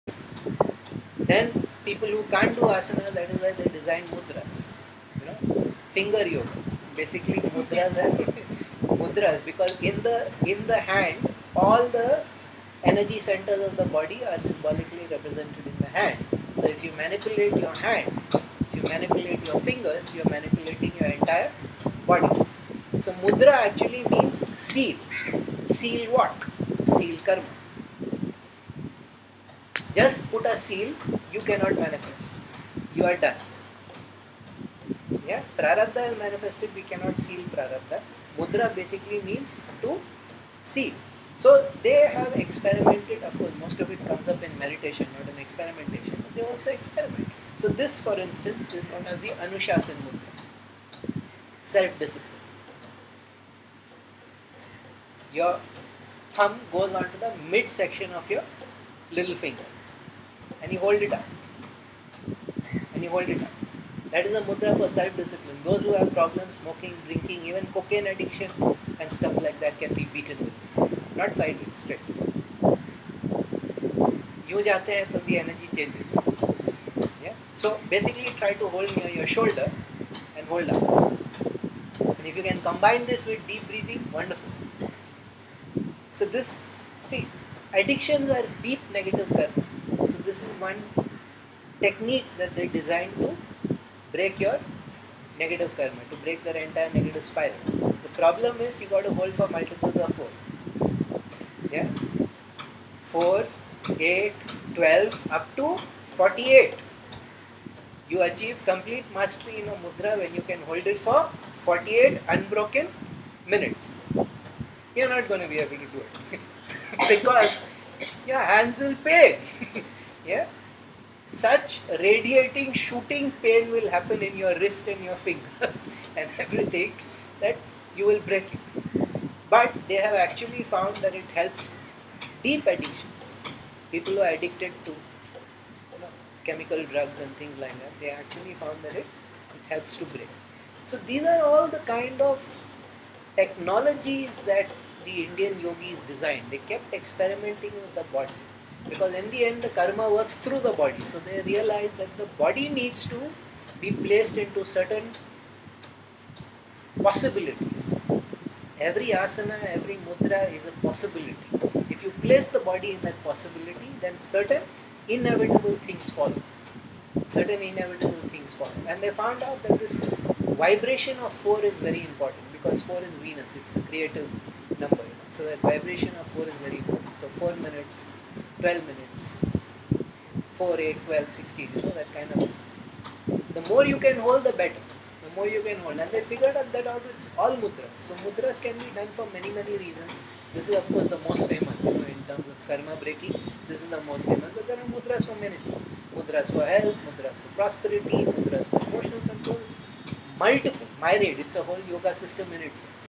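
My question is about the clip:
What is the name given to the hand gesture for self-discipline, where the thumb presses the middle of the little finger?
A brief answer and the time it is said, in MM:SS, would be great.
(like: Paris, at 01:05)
Anushasan Mudra, at 00:49.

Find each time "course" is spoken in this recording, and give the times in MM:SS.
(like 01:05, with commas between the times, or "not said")
00:43, 03:10.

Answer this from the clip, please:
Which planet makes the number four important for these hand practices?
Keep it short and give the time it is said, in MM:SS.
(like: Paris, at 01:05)
Venus, at 02:52.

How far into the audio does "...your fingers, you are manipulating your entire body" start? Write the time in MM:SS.
00:19.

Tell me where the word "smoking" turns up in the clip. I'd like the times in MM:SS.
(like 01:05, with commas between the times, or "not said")
01:06.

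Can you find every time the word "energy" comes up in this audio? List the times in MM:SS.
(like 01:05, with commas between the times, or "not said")
00:12, 01:15.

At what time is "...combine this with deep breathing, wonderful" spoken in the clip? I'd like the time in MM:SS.
01:22.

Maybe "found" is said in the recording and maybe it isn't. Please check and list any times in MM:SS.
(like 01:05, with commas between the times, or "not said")
02:10, 02:18, 02:49.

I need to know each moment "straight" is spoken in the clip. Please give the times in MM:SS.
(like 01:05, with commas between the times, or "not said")
01:11.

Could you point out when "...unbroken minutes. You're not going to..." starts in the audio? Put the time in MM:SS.
01:52.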